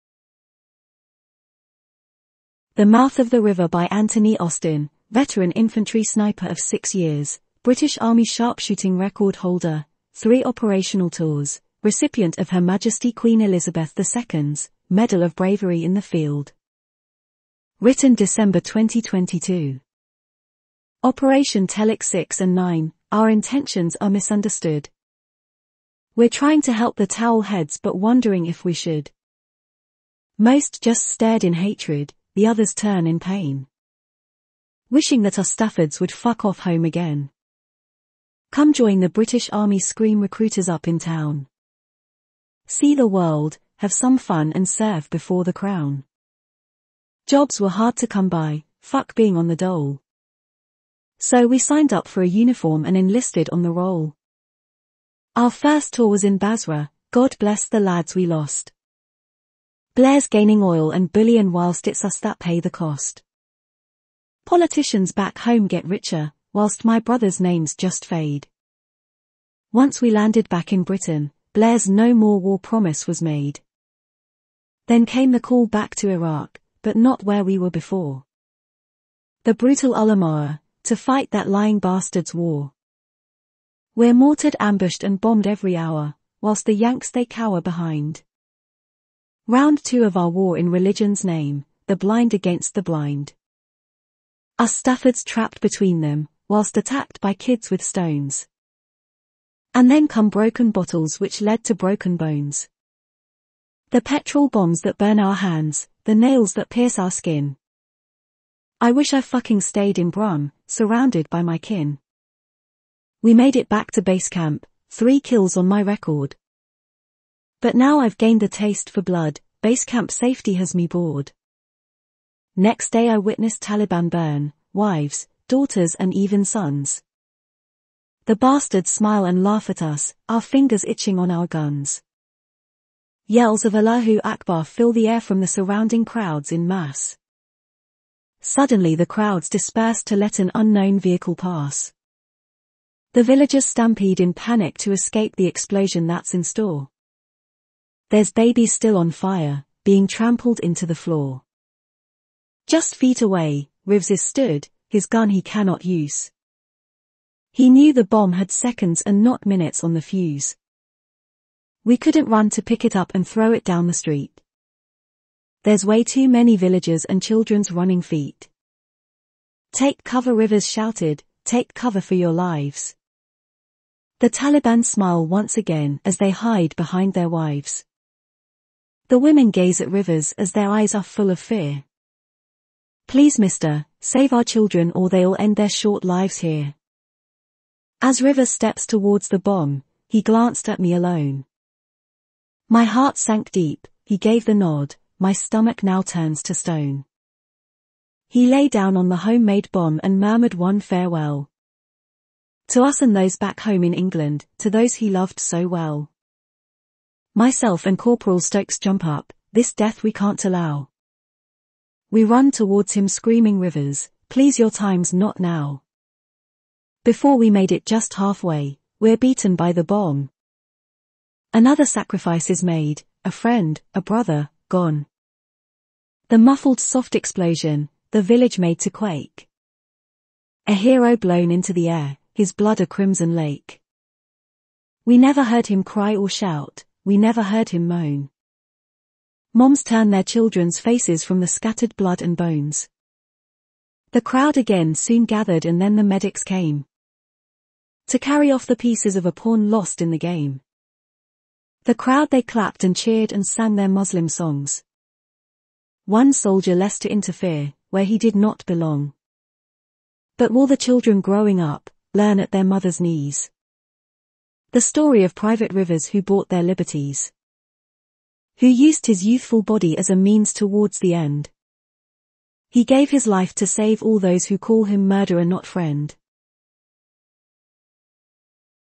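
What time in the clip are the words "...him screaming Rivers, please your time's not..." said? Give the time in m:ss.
3:32.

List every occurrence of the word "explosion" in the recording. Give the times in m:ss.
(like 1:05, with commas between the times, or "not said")
2:25, 3:47.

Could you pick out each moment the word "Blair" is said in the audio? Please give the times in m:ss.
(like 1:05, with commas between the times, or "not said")
0:59, 1:11.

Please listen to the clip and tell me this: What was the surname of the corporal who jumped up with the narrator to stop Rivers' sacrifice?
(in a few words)
Stokes.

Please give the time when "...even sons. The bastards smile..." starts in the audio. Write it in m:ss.
2:06.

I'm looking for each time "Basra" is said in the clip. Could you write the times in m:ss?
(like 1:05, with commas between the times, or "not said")
0:56.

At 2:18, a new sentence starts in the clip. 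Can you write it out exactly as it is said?
Suddenly the crowds disperse to let an unknown vehicle pass.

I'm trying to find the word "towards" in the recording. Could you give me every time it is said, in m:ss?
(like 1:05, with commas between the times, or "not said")
3:08, 3:32, 4:30.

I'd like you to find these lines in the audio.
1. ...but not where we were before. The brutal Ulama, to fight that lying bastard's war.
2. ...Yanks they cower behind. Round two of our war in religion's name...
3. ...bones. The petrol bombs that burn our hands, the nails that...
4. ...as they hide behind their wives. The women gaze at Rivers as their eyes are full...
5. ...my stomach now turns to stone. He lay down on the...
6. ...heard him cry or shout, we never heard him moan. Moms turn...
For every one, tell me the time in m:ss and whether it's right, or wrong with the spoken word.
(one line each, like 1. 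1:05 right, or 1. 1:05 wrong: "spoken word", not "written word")
1. 1:16 right
2. 1:26 right
3. 1:42 right
4. 2:56 right
5. 3:15 right
6. 3:55 right.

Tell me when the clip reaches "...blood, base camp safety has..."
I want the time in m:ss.
1:59.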